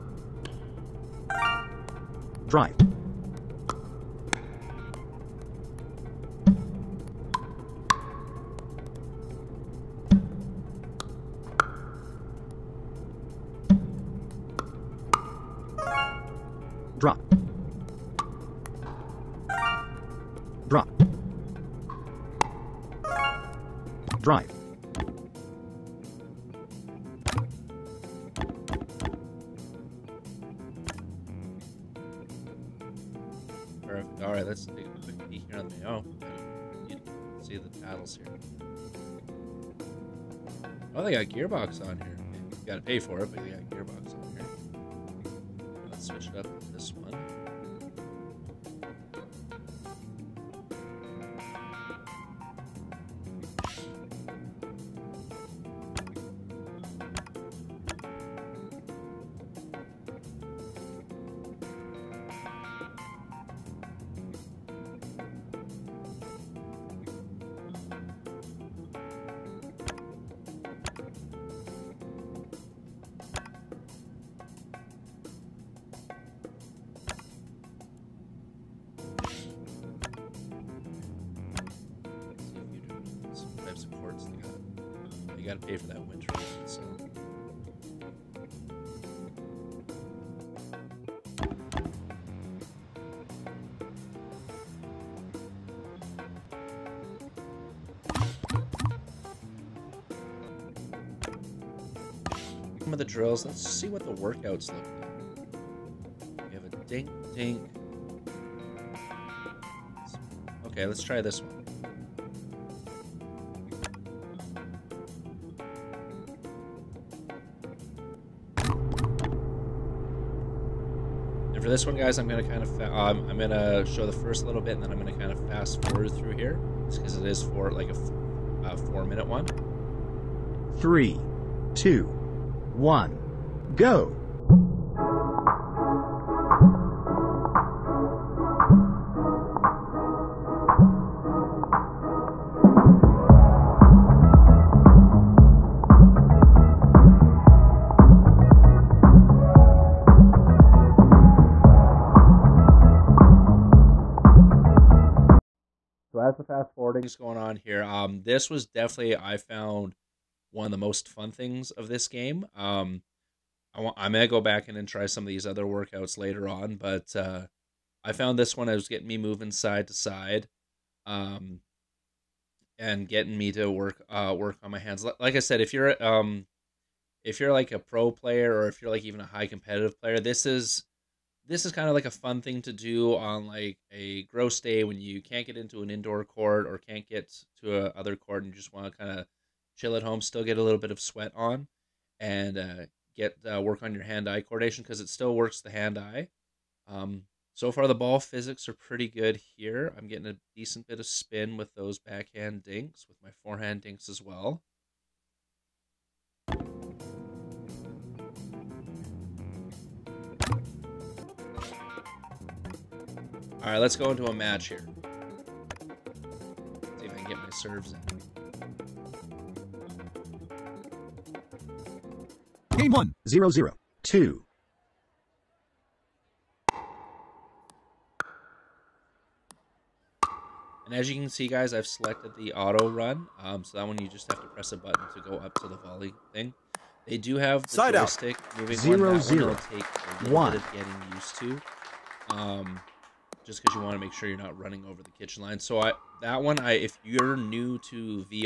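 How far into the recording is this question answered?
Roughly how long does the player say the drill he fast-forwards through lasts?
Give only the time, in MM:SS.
02:08.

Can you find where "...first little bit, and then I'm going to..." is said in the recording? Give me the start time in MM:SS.
02:04.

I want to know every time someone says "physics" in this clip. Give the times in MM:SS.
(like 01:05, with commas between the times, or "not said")
03:18.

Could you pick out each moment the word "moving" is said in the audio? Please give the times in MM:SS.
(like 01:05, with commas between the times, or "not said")
02:49, 03:58.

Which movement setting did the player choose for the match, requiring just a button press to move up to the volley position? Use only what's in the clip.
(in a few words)
Auto run.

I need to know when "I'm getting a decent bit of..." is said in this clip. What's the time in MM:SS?
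03:19.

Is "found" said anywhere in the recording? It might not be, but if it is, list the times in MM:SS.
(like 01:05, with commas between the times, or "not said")
02:39, 02:48.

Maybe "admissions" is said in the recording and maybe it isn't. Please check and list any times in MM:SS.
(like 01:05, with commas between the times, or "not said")
not said.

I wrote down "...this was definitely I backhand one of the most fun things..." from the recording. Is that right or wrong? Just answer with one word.
wrong.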